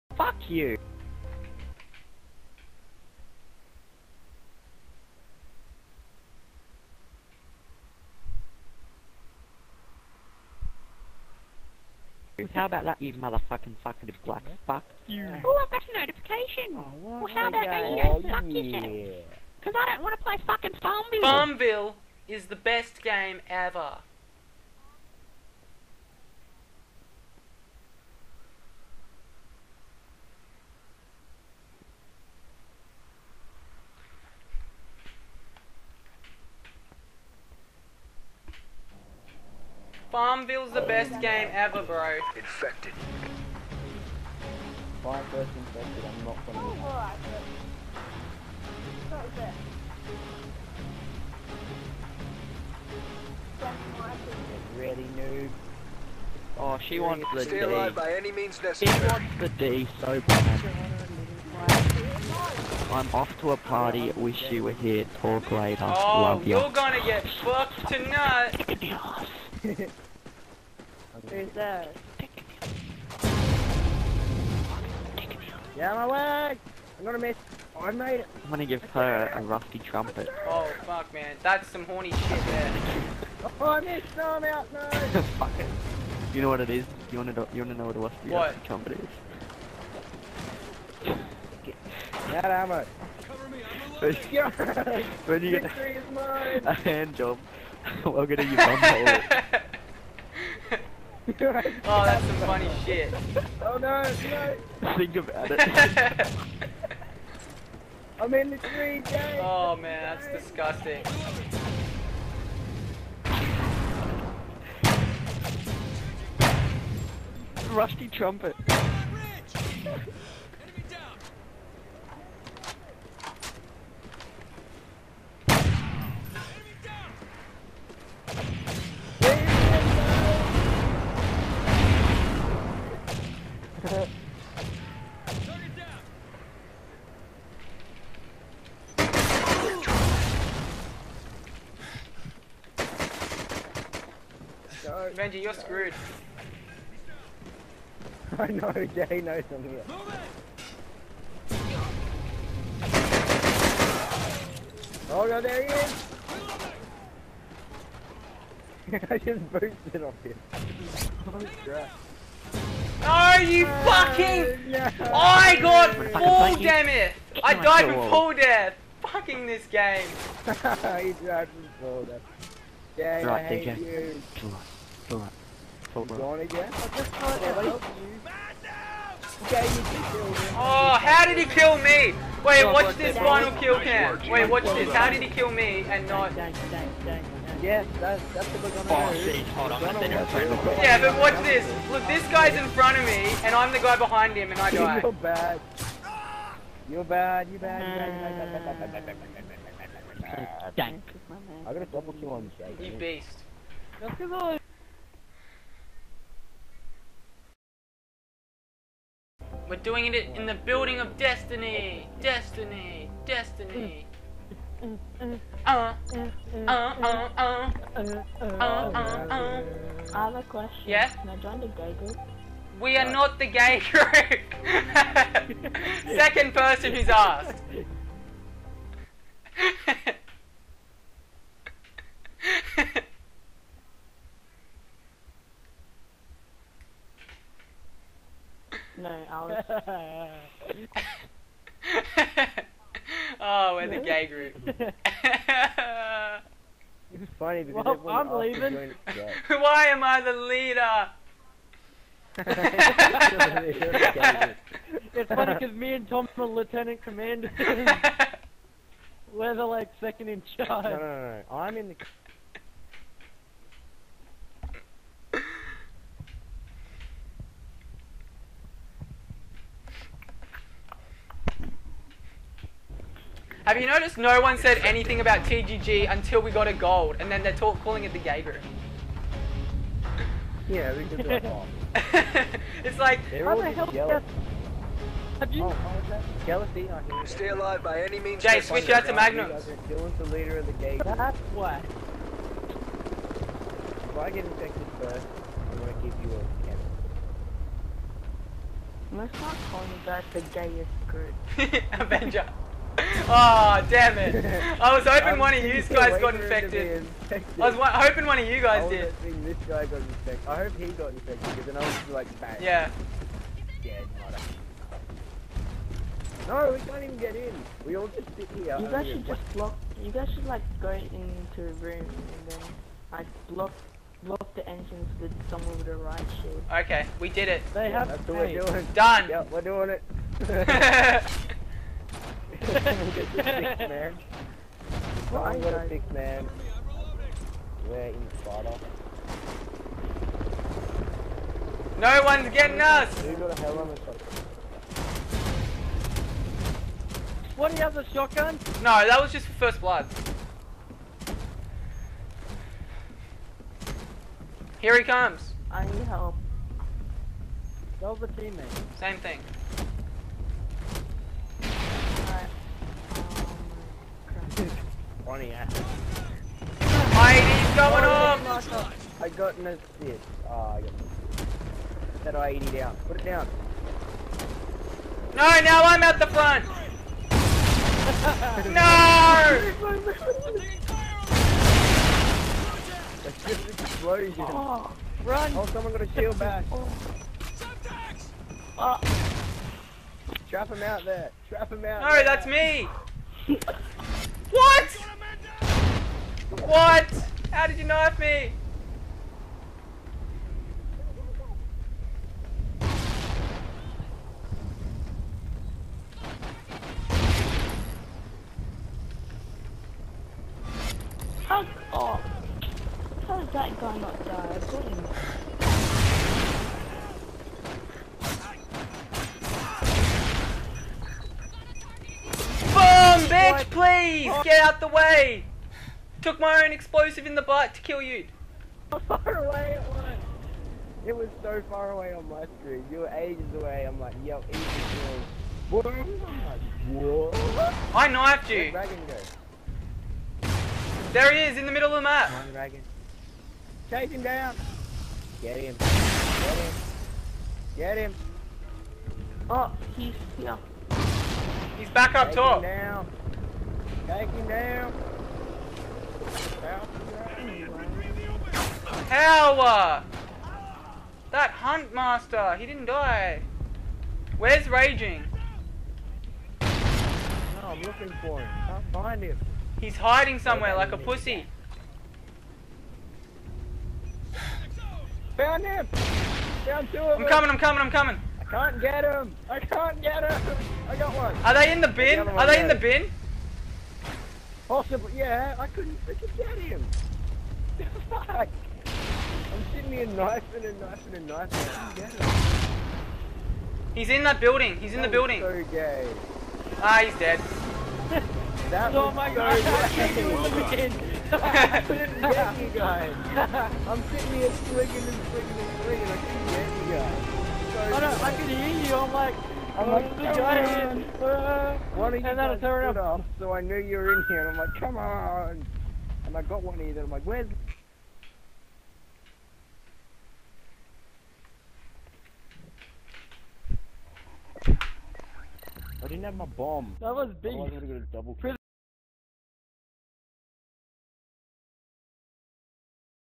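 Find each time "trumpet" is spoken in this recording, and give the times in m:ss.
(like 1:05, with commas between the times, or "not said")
1:19, 1:28, 1:58.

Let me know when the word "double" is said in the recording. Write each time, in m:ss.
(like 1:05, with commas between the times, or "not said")
3:21, 8:48.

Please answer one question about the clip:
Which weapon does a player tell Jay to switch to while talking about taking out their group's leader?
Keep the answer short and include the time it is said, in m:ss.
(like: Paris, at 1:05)
Magnum, at 4:49.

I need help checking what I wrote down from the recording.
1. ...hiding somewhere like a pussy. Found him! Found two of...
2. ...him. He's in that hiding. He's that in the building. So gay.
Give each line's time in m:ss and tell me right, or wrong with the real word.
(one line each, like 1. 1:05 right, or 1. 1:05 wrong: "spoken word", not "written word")
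1. 7:49 right
2. 8:12 wrong: "building", not "hiding".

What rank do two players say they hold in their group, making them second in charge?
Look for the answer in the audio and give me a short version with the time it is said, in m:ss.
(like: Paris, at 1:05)
Lieutenant commanders, at 4:16.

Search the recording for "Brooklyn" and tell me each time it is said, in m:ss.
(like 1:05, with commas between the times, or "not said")
not said.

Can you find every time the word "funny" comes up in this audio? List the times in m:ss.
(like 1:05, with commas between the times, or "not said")
1:42, 4:07, 4:15, 6:05.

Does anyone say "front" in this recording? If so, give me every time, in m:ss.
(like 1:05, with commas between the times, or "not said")
3:12, 6:16.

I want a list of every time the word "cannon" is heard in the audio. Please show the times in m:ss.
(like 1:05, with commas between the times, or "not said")
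4:56.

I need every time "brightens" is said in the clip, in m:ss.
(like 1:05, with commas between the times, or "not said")
not said.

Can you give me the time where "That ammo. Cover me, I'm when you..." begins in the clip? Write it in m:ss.
1:32.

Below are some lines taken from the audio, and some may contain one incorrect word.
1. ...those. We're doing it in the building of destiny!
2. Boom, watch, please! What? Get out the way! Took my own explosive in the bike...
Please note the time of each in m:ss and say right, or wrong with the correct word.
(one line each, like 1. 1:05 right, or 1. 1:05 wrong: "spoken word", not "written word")
1. 3:24 right
2. 7:02 wrong: "bitch", not "watch".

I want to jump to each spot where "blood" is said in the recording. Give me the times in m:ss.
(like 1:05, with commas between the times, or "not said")
5:49.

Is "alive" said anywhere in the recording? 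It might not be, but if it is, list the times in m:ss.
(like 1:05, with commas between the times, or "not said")
0:57, 4:47.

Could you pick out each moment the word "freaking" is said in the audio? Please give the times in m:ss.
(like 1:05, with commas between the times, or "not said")
8:06.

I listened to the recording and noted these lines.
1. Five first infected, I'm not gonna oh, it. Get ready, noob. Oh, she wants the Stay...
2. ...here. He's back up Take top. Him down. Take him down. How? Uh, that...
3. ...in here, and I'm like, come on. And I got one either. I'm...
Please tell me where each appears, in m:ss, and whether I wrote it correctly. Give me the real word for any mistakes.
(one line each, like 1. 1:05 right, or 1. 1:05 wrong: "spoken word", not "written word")
1. 0:45 right
2. 7:30 right
3. 8:34 right.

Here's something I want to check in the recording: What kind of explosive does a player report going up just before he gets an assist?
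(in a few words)
IED.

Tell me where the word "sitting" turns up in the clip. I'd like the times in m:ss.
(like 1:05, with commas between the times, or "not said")
8:09, 8:24.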